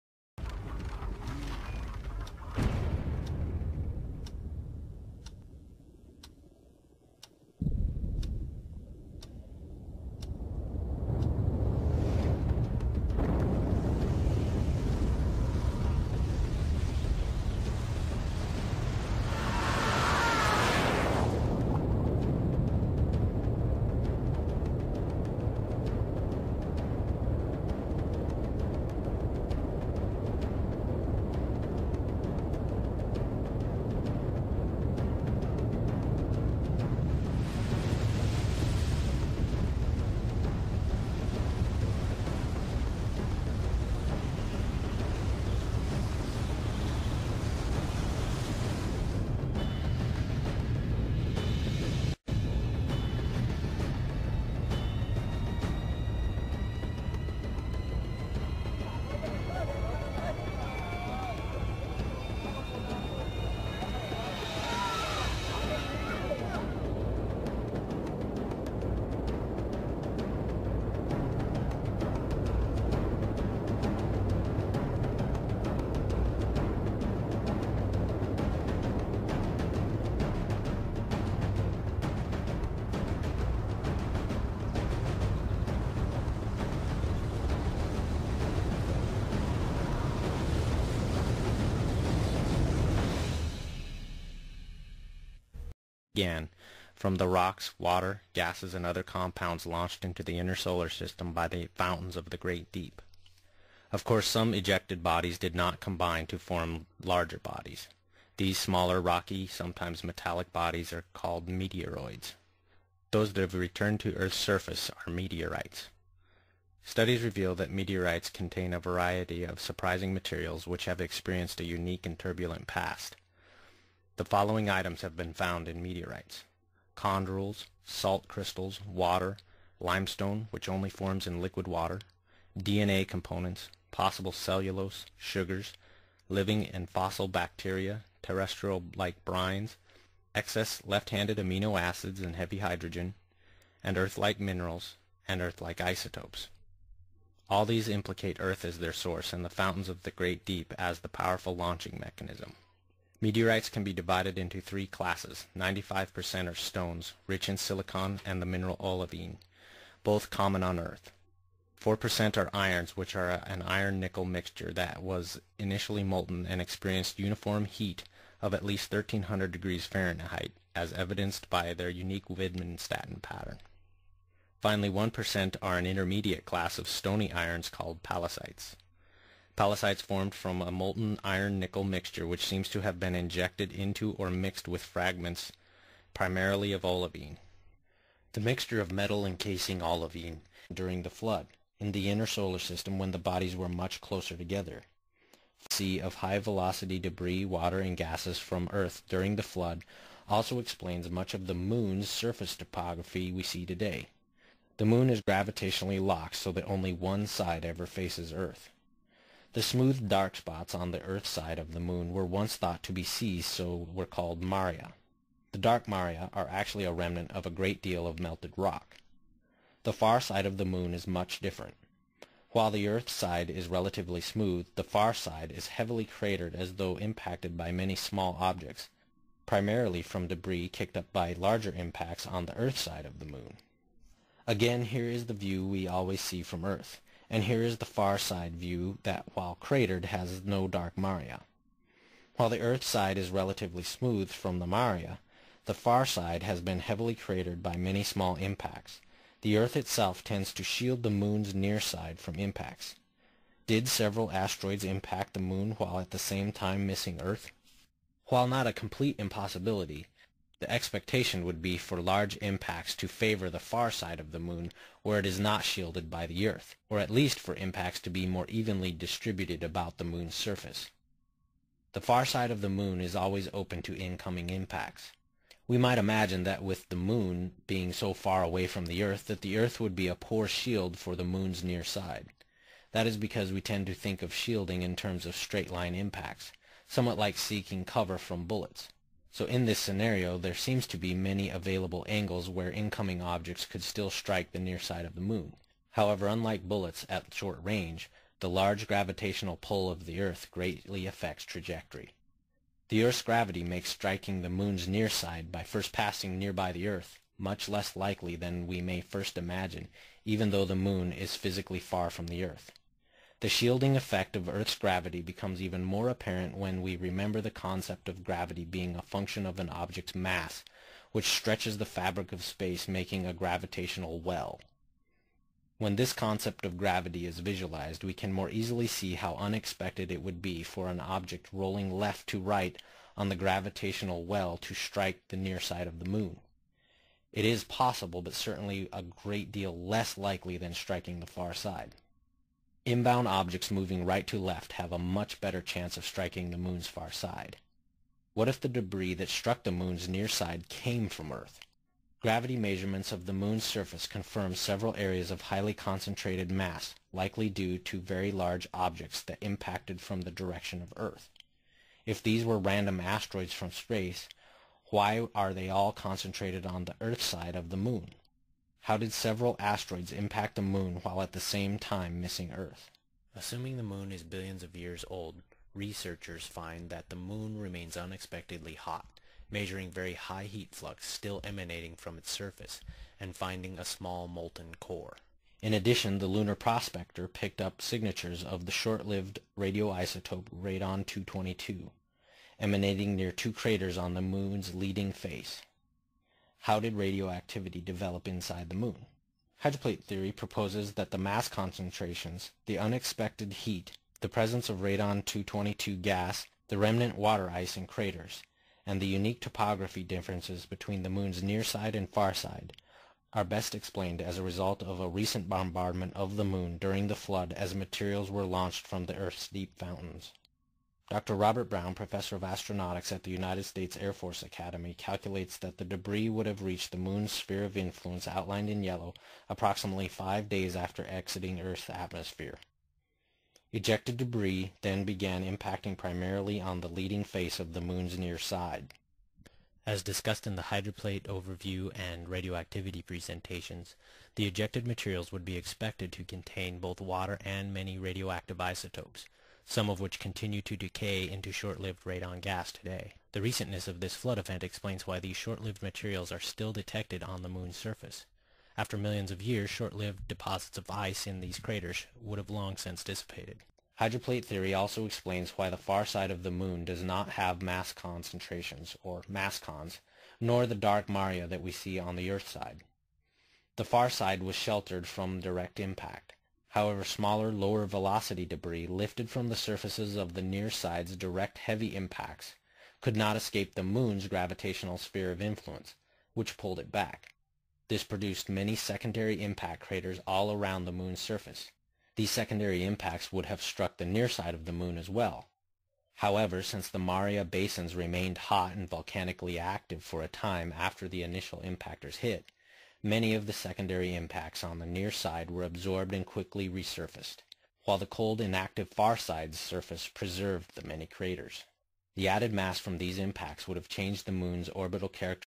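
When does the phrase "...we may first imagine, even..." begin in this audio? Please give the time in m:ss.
5:08.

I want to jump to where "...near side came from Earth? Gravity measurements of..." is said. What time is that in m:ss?
5:50.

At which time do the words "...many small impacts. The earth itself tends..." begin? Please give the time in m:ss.
4:07.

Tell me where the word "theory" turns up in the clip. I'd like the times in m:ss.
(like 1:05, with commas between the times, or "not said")
6:40, 7:44.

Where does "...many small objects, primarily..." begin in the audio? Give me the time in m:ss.
3:47.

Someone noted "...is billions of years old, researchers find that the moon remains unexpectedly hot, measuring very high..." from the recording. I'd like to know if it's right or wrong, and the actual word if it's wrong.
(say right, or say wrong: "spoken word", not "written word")
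right.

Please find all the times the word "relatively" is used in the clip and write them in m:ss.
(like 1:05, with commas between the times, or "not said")
3:43, 4:03.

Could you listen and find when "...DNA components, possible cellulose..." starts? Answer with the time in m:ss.
2:12.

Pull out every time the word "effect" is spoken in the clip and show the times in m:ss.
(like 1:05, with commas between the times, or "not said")
5:13.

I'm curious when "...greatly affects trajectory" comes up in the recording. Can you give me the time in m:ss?
5:00.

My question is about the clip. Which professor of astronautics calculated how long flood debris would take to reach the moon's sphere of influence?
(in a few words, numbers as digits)
Robert Brown.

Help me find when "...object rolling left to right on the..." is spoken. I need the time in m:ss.
5:30.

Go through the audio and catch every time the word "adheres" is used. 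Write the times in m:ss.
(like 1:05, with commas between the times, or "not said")
not said.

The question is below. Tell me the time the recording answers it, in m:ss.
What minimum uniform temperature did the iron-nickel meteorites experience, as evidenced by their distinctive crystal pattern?
2:48.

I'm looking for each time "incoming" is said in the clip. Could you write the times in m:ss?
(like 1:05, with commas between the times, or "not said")
4:33, 4:52.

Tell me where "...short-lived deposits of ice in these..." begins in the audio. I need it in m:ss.
7:39.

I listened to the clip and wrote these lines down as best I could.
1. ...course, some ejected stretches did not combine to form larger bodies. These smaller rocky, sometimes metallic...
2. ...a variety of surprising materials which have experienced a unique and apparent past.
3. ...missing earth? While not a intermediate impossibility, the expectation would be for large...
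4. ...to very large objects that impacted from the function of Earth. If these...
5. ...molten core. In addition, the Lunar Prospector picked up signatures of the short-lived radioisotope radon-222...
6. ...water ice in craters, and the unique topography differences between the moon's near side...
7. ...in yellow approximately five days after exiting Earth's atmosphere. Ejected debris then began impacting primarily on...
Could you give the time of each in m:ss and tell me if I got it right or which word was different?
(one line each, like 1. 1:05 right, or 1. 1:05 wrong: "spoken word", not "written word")
1. 1:44 wrong: "bodies", not "stretches"
2. 1:58 wrong: "turbulent", not "apparent"
3. 4:16 wrong: "complete", not "intermediate"
4. 5:57 wrong: "direction", not "function"
5. 6:24 right
6. 6:47 right
7. 7:08 right.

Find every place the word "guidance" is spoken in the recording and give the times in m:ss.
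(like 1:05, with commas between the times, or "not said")
not said.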